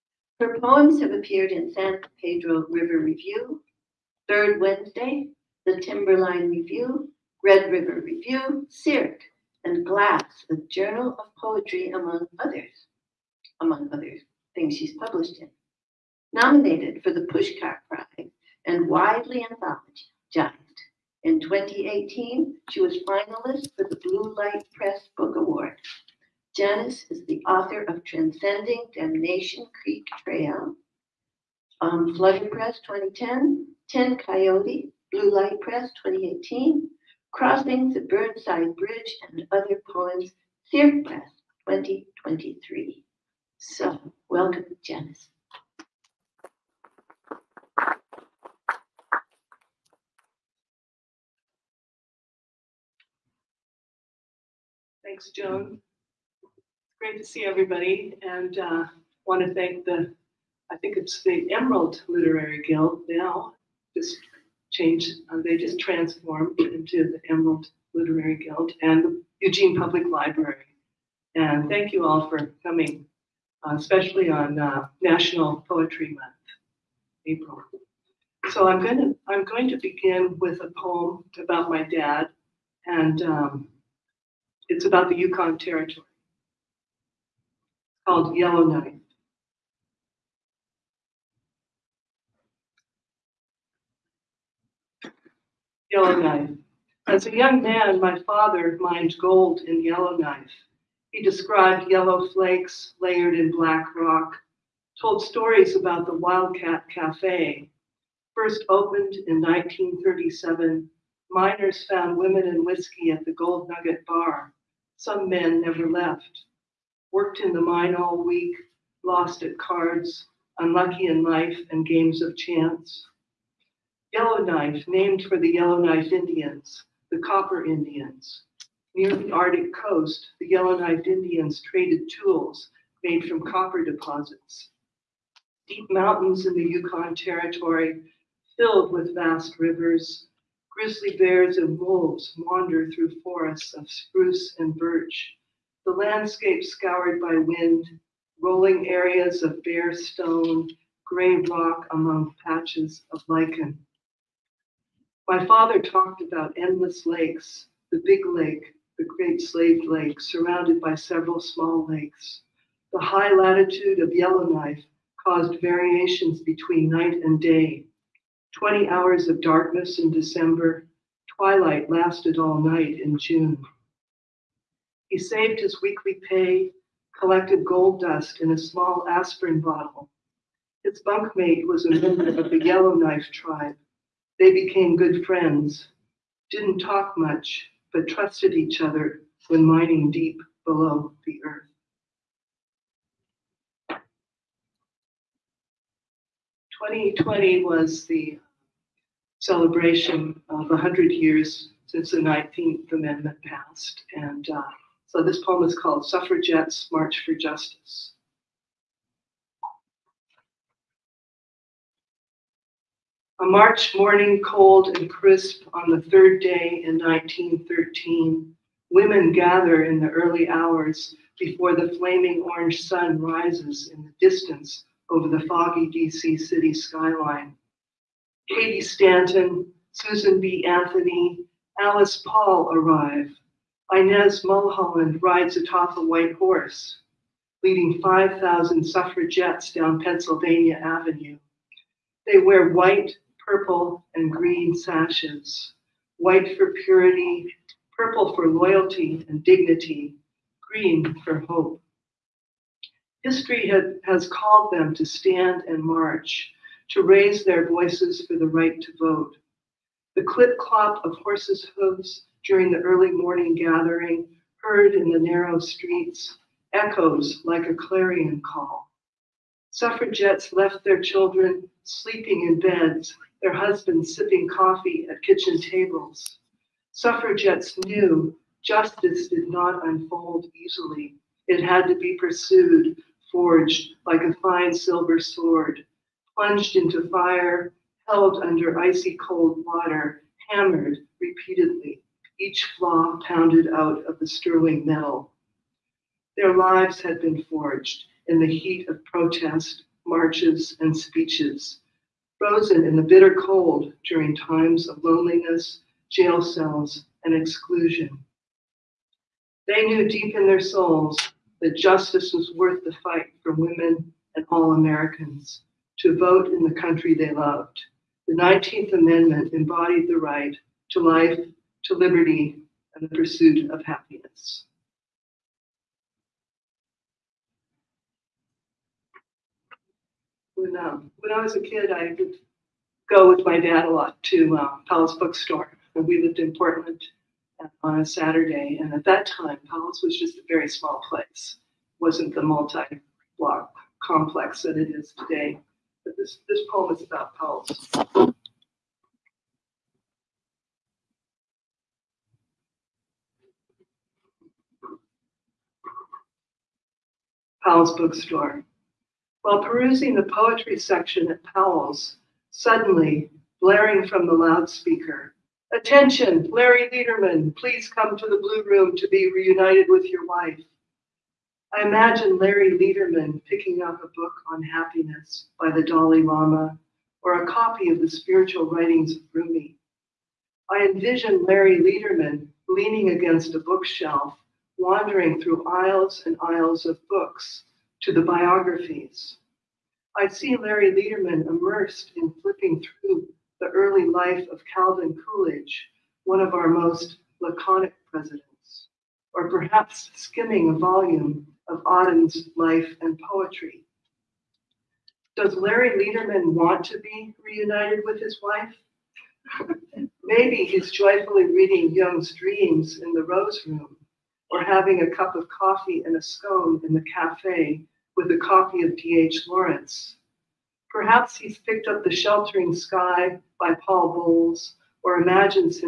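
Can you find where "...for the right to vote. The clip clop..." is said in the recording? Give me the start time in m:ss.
4:18.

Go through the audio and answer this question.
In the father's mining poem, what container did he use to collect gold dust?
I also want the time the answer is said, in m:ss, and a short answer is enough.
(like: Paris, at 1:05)
small aspirin bottle, at 2:58.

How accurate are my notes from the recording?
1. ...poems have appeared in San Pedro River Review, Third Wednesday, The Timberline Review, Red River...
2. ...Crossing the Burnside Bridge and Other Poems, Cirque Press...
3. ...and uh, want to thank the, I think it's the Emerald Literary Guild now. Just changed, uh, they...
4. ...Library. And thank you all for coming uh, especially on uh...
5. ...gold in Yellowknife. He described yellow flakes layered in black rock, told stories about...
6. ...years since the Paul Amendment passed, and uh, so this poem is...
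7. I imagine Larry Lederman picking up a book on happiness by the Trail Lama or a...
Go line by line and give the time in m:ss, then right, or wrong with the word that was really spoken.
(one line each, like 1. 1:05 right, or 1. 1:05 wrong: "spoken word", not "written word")
1. 0:00 right
2. 0:37 right
3. 0:58 right
4. 1:10 right
5. 1:39 right
6. 3:21 wrong: "Nineteenth", not "Paul"
7. 6:11 wrong: "Dalai", not "Trail".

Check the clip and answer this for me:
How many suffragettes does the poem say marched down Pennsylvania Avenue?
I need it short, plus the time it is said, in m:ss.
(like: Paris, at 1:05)
5,000, at 3:58.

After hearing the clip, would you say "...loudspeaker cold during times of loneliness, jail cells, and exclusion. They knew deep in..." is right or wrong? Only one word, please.
wrong.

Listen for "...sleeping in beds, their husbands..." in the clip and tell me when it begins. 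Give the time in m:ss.
4:31.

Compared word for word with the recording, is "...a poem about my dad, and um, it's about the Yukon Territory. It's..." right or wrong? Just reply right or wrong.
right.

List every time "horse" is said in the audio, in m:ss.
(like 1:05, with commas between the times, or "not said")
3:56, 4:21.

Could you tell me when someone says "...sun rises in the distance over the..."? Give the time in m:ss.
3:42.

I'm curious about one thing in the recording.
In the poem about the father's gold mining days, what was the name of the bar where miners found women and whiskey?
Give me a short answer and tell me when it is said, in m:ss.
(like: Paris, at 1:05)
Gold Nugget Bar, at 1:53.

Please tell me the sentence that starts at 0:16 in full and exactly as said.
Nominated for the Pushcart Prize and widely anthologized.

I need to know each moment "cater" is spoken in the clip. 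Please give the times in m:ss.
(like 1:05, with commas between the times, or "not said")
not said.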